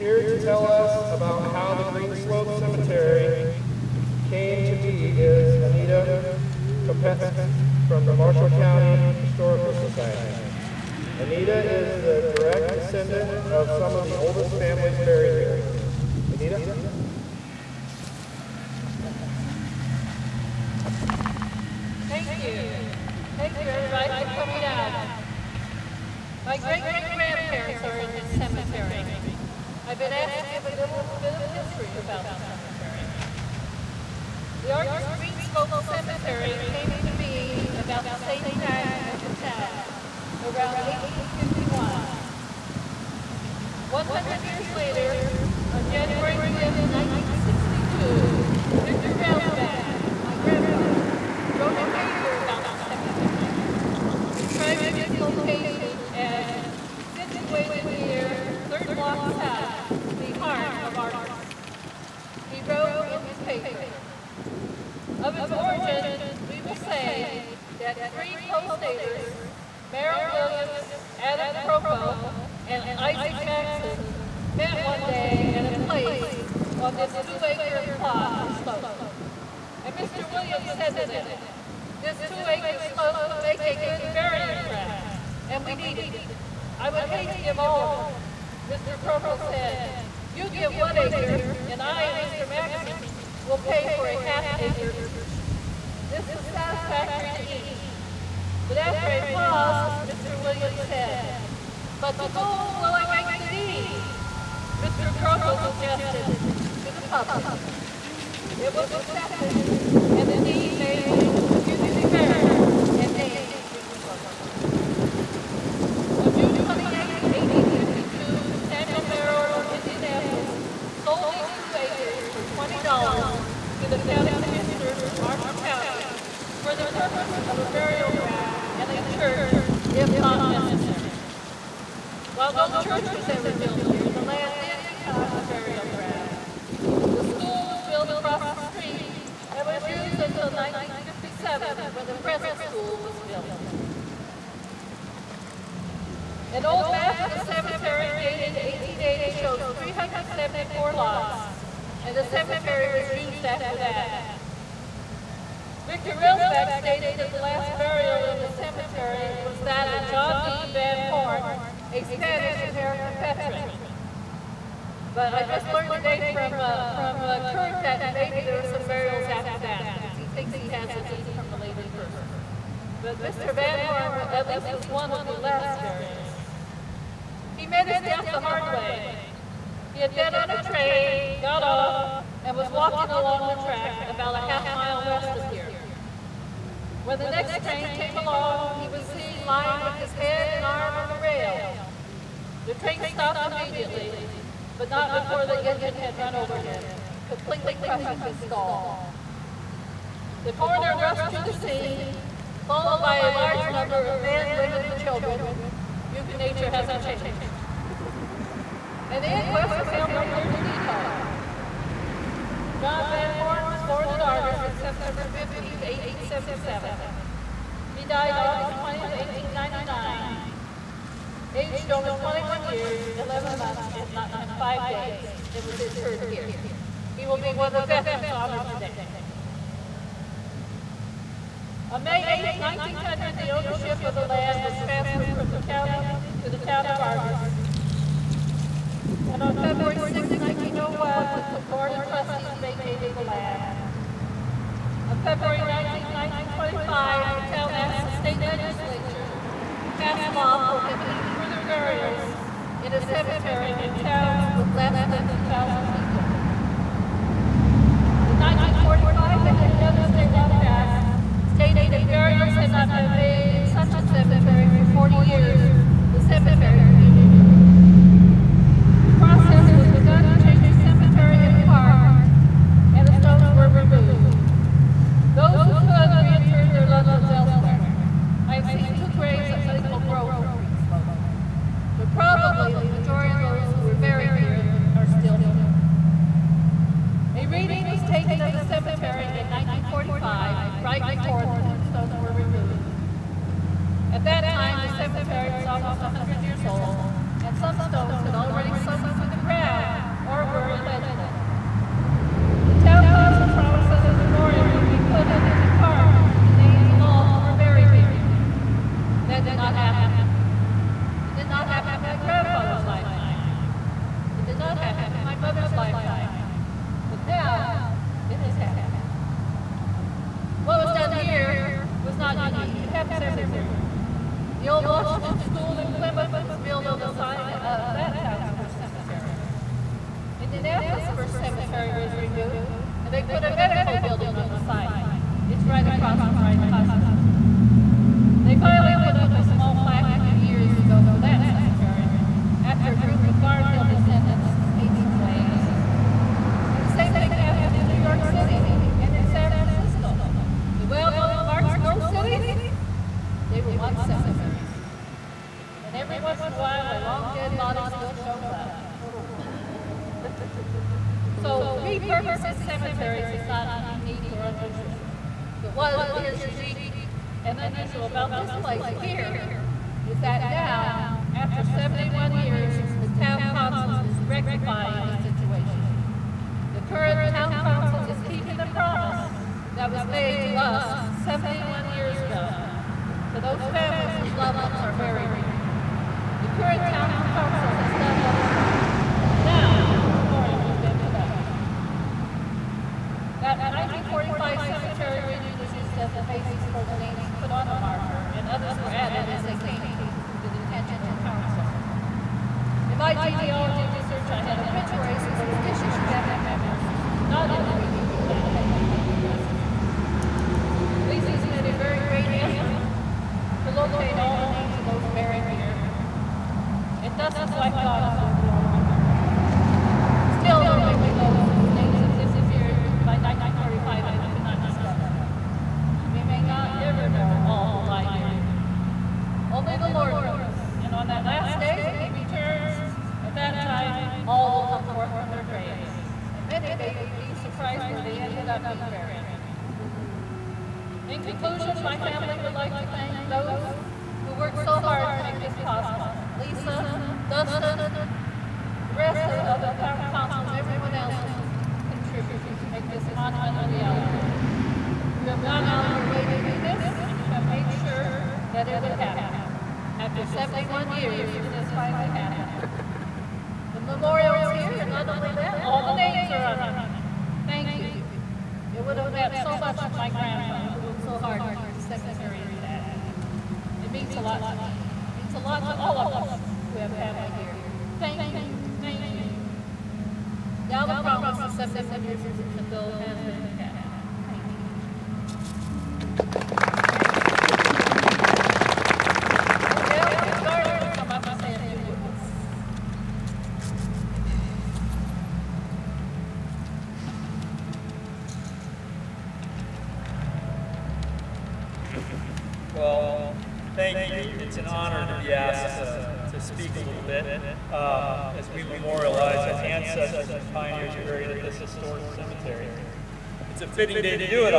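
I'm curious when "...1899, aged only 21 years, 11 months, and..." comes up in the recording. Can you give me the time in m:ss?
3:39.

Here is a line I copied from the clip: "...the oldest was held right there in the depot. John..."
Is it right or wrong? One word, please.
wrong.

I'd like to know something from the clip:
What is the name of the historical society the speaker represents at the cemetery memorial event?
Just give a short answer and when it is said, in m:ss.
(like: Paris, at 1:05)
Marshall County Historical Society, at 0:08.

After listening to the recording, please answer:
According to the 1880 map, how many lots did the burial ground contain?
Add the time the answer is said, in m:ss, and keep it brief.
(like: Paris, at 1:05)
374, at 2:29.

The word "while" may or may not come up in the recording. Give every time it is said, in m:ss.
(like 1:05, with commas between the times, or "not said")
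2:12, 5:56.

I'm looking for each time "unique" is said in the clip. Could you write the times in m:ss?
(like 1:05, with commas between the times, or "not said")
5:22, 6:06.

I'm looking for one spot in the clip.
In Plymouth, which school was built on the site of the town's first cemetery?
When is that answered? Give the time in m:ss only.
5:24.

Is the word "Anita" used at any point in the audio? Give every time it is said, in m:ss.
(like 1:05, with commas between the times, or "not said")
0:05, 0:11, 0:16.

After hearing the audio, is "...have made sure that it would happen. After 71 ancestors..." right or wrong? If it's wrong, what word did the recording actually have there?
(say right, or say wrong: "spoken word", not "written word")
wrong: "years", not "ancestors".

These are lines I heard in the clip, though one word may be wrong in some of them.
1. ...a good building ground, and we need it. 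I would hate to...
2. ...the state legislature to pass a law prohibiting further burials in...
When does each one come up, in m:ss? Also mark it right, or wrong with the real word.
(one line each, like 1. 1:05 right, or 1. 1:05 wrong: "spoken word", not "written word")
1. 1:23 wrong: "burying", not "building"
2. 4:08 right.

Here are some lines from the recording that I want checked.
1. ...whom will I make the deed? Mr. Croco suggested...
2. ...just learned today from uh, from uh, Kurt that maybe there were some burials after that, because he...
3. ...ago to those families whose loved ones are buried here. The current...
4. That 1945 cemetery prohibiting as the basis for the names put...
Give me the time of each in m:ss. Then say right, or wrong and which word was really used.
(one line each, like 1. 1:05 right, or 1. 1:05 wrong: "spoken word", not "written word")
1. 1:42 right
2. 2:45 right
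3. 6:22 right
4. 6:33 wrong: "reading", not "prohibiting".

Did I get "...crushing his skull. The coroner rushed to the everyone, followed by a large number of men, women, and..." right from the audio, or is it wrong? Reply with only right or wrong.
wrong.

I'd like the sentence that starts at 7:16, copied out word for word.
And many may be surprised where they ended up being buried.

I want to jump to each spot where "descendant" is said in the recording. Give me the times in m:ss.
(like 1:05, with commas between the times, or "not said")
0:12, 5:43.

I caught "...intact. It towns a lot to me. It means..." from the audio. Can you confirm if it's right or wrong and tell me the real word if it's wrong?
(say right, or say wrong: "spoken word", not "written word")
wrong: "means", not "towns".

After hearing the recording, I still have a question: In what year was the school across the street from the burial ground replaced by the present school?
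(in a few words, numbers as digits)
1957.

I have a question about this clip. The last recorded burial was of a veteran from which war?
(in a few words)
Spanish-American.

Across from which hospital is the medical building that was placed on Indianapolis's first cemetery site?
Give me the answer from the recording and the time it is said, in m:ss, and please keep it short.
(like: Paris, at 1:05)
Riley Hospital, at 5:36.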